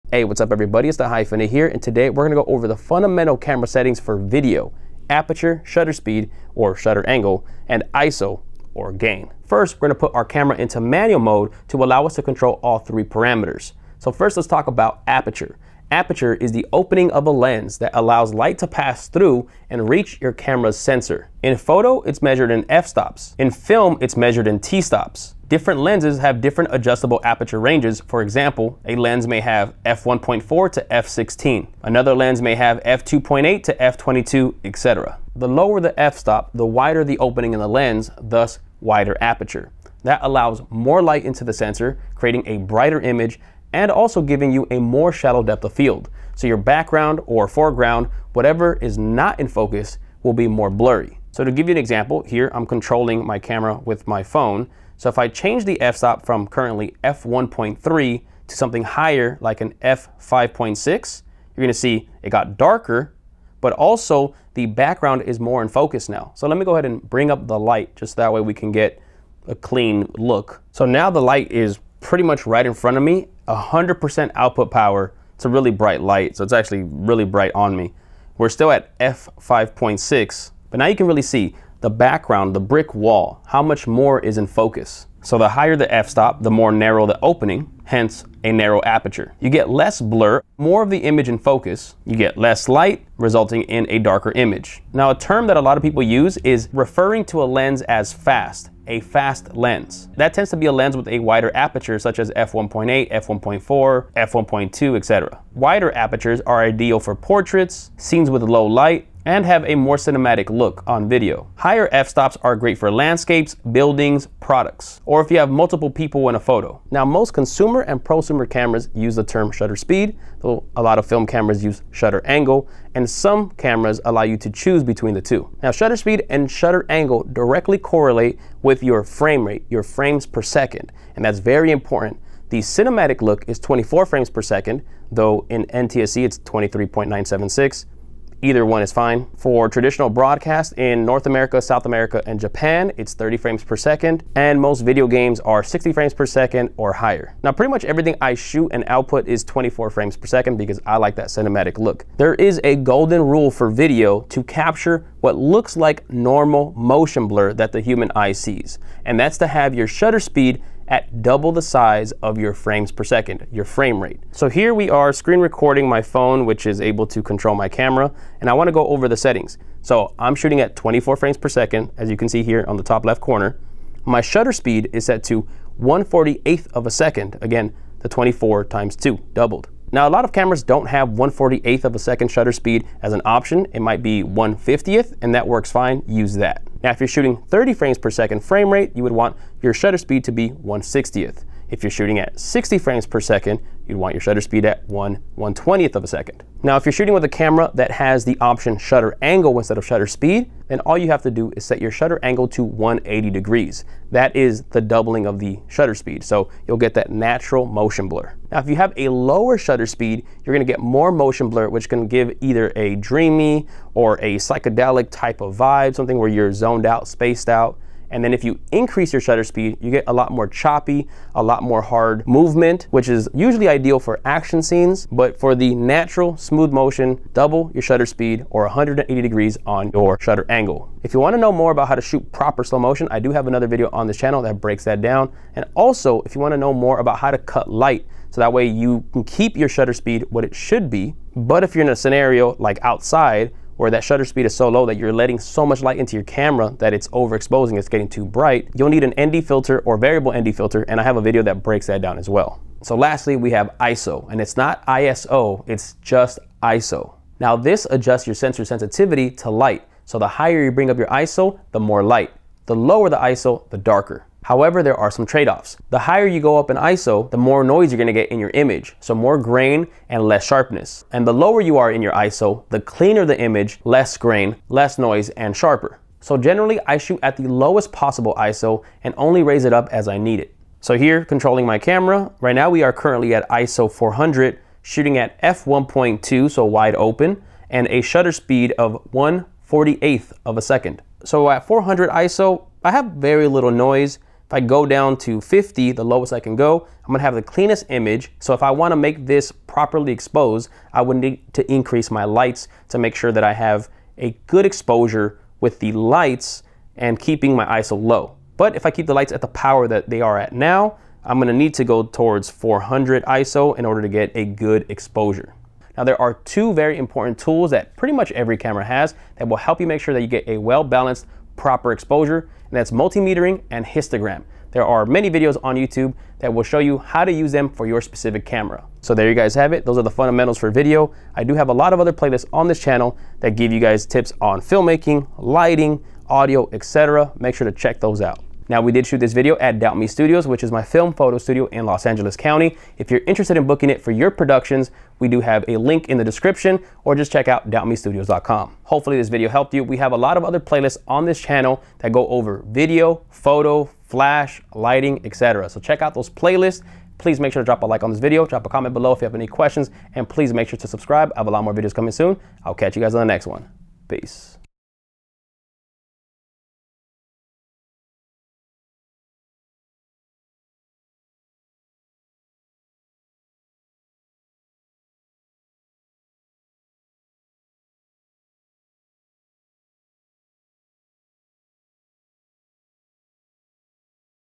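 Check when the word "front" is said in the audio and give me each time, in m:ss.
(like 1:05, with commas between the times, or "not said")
1:12.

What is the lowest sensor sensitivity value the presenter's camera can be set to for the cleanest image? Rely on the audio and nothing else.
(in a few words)
50.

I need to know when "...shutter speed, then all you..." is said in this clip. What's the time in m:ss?
3:19.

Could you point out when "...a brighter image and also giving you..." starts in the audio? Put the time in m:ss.
0:42.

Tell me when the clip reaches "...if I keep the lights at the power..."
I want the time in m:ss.
5:08.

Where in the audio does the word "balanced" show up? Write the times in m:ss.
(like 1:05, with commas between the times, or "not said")
5:20.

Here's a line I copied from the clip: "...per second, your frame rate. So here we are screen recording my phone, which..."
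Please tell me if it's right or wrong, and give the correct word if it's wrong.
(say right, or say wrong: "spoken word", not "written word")
right.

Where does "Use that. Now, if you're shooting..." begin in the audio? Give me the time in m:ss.
3:06.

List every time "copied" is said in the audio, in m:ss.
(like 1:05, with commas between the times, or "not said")
not said.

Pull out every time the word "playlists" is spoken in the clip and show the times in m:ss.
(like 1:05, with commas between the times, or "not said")
5:32, 5:50, 5:56.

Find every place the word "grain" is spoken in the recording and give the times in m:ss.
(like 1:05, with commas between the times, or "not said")
4:29, 4:34.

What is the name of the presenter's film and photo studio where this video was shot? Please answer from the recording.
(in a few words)
Doubt Me Studios.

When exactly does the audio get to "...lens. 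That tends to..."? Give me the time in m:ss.
1:39.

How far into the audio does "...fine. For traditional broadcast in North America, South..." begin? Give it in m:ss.
2:18.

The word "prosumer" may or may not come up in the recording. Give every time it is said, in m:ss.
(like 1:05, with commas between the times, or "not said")
1:58.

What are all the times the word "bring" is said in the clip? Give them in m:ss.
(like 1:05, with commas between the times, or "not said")
1:07, 4:20.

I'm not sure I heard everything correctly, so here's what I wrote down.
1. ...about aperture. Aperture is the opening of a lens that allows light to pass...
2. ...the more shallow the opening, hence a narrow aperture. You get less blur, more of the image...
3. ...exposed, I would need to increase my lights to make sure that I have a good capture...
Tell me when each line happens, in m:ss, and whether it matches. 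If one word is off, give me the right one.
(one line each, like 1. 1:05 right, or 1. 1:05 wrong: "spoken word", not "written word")
1. 0:14 right
2. 1:26 wrong: "narrow", not "shallow"
3. 5:00 wrong: "exposure", not "capture".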